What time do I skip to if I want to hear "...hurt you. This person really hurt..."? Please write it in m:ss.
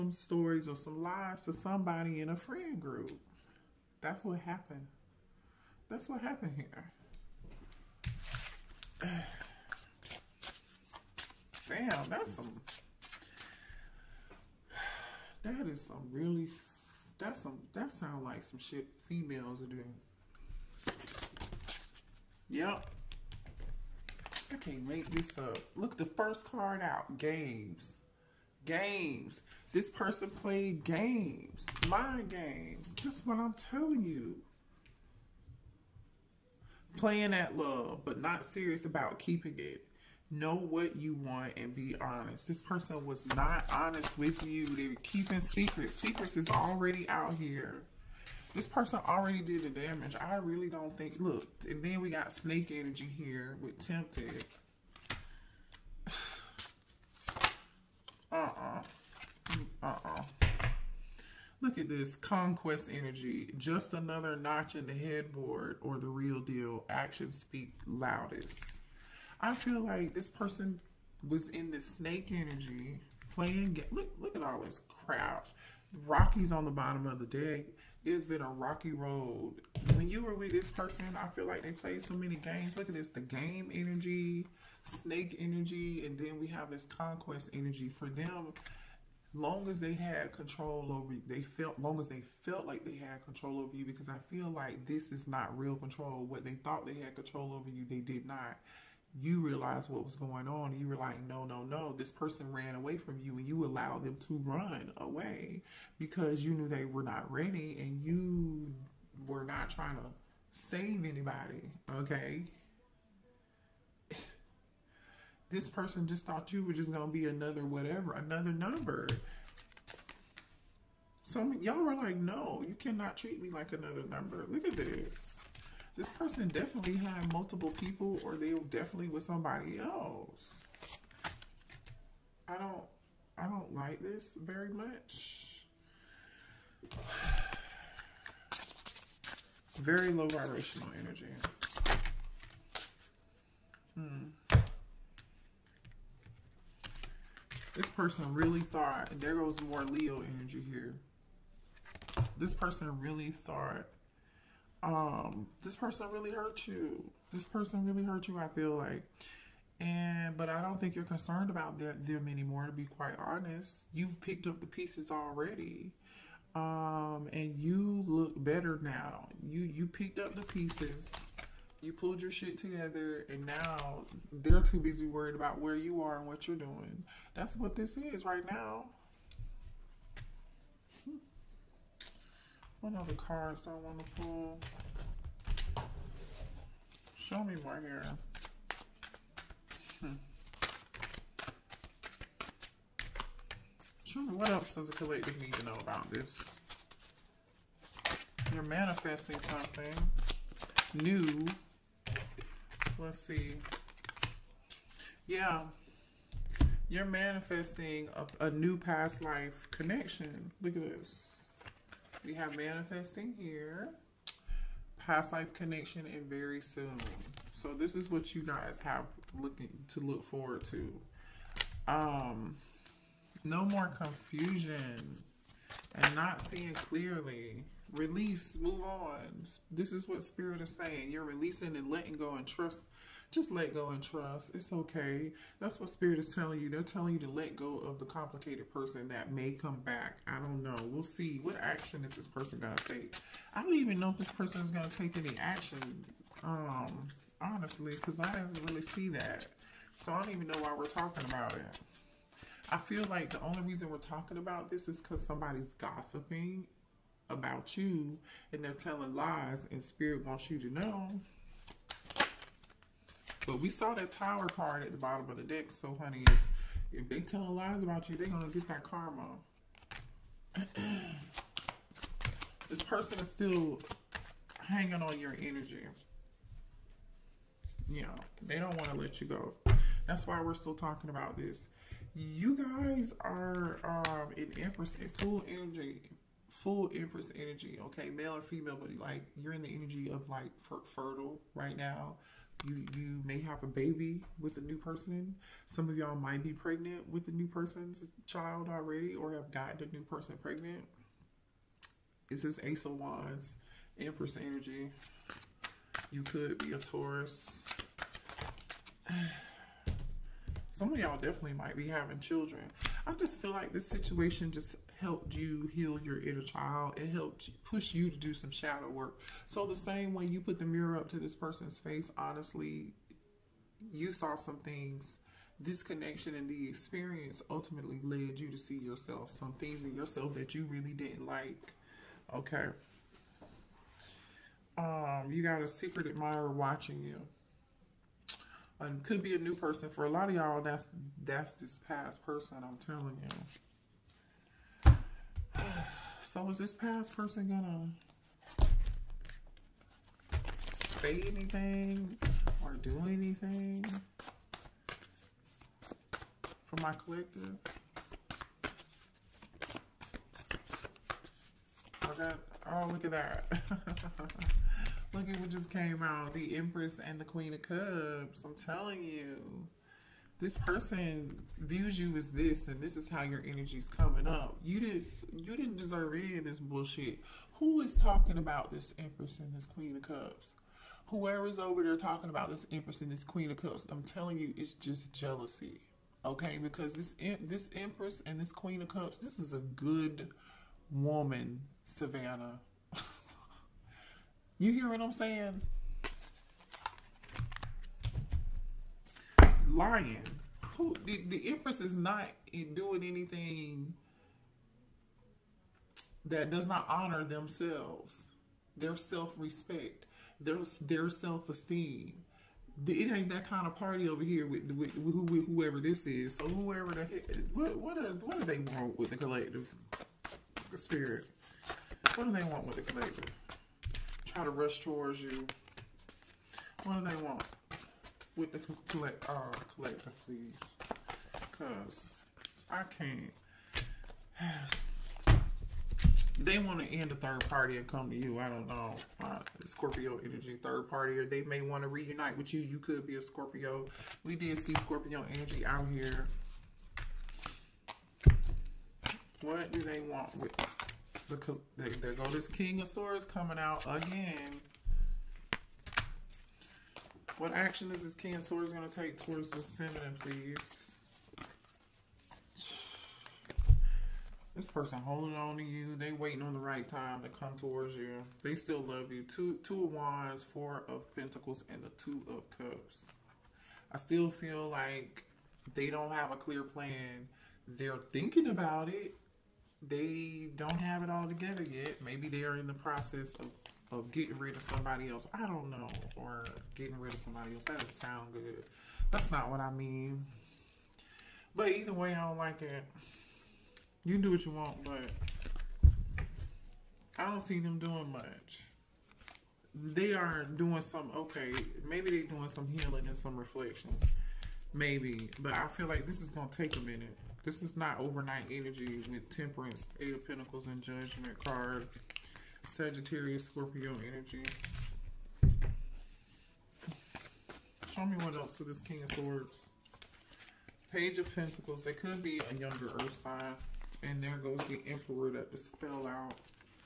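2:36.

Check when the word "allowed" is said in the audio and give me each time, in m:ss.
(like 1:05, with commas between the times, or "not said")
1:43.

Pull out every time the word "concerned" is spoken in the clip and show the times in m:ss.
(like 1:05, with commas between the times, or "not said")
2:41.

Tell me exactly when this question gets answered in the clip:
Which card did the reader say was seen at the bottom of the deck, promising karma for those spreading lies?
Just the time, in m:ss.
4:24.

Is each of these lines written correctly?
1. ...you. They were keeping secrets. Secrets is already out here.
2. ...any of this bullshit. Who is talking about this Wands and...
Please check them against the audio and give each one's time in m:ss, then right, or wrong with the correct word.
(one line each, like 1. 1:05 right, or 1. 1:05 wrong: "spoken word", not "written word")
1. 0:44 right
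2. 6:16 wrong: "Empress", not "Wands".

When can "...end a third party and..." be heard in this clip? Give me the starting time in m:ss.
7:16.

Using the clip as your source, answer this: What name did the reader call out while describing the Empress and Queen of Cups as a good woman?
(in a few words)
Savannah.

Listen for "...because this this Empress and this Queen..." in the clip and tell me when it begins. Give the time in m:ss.
6:26.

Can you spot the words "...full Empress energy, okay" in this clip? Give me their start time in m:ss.
4:46.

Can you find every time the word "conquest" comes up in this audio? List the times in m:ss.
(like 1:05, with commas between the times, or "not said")
1:02, 1:26.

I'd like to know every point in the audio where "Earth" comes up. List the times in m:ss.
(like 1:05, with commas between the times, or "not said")
8:43.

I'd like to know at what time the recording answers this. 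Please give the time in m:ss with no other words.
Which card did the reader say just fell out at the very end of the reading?
8:44.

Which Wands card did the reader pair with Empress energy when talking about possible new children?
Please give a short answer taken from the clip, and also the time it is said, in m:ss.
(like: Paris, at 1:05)
Ace of Wands, at 5:02.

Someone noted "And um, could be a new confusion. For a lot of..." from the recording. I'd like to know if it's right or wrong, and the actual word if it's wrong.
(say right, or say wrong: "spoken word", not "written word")
wrong: "person", not "confusion".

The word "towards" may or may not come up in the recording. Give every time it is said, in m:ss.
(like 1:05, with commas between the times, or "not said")
7:04, 7:39, 7:47.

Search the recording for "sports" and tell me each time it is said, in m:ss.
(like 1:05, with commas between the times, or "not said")
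not said.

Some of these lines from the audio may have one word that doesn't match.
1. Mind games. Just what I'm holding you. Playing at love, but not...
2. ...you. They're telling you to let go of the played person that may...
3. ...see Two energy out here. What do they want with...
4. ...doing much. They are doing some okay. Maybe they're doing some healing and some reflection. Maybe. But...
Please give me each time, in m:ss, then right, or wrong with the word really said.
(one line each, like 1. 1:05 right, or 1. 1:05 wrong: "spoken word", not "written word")
1. 0:31 wrong: "telling", not "holding"
2. 3:56 wrong: "complicated", not "played"
3. 7:24 wrong: "Scorpio", not "Two"
4. 8:17 right.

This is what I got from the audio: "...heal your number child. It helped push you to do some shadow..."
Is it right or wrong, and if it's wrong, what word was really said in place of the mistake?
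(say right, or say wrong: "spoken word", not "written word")
wrong: "inner", not "number".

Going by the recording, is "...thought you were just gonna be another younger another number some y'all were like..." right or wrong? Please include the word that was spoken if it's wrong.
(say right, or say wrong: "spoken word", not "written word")
wrong: "whatever", not "younger".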